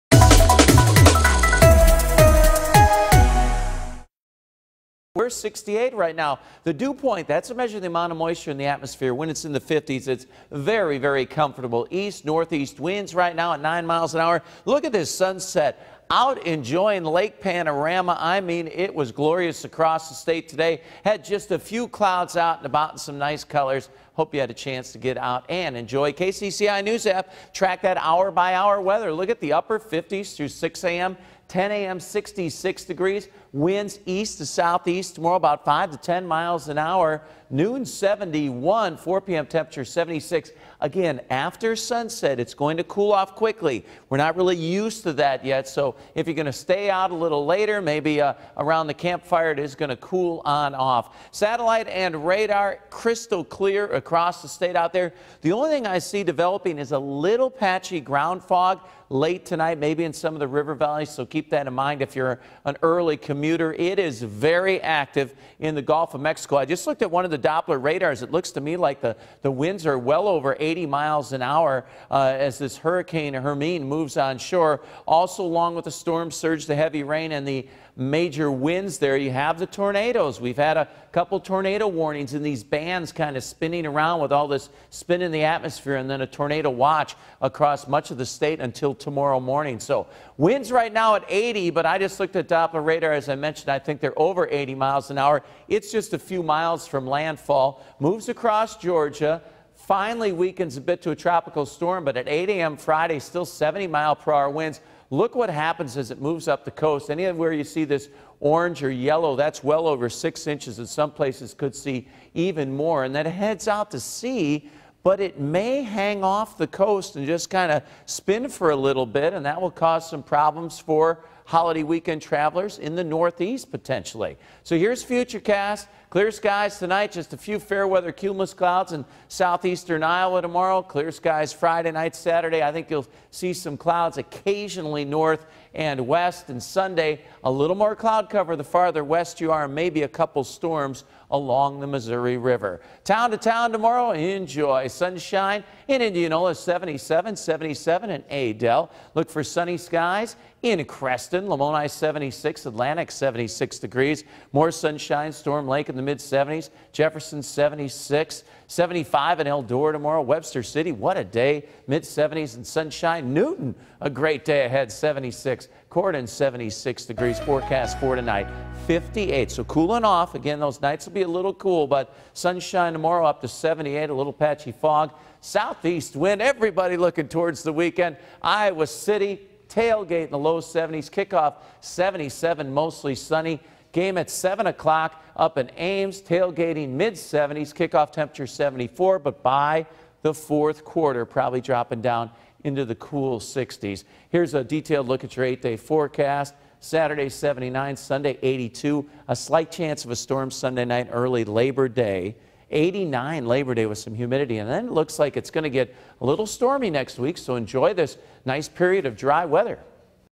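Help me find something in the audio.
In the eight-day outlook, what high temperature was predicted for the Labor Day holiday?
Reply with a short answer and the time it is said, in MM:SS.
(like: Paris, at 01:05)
89, at 03:22.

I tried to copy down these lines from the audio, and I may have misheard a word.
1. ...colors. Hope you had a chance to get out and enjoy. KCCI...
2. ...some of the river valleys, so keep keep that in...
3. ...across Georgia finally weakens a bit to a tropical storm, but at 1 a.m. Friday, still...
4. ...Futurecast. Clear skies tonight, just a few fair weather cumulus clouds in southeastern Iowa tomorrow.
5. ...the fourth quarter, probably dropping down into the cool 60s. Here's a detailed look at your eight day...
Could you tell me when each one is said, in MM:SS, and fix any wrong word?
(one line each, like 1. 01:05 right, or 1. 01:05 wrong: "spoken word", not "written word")
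1. 00:23 right
2. 01:00 right
3. 01:38 wrong: "8", not "1"
4. 02:05 right
5. 03:10 right.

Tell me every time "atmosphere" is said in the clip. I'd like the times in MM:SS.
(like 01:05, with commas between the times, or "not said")
00:08, 01:25.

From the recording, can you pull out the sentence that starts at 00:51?
Satellite and radar crystal clear across the state out there.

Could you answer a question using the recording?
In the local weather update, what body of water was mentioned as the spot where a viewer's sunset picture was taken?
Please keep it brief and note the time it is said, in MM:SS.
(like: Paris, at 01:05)
Lake Panorama, at 00:17.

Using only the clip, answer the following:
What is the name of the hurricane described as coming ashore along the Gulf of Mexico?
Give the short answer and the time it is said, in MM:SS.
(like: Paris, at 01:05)
Hermine, at 01:13.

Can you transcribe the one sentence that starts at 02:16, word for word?
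And Sunday, a little more cloud cover the farther west you are, maybe a couple storms along the Missouri River.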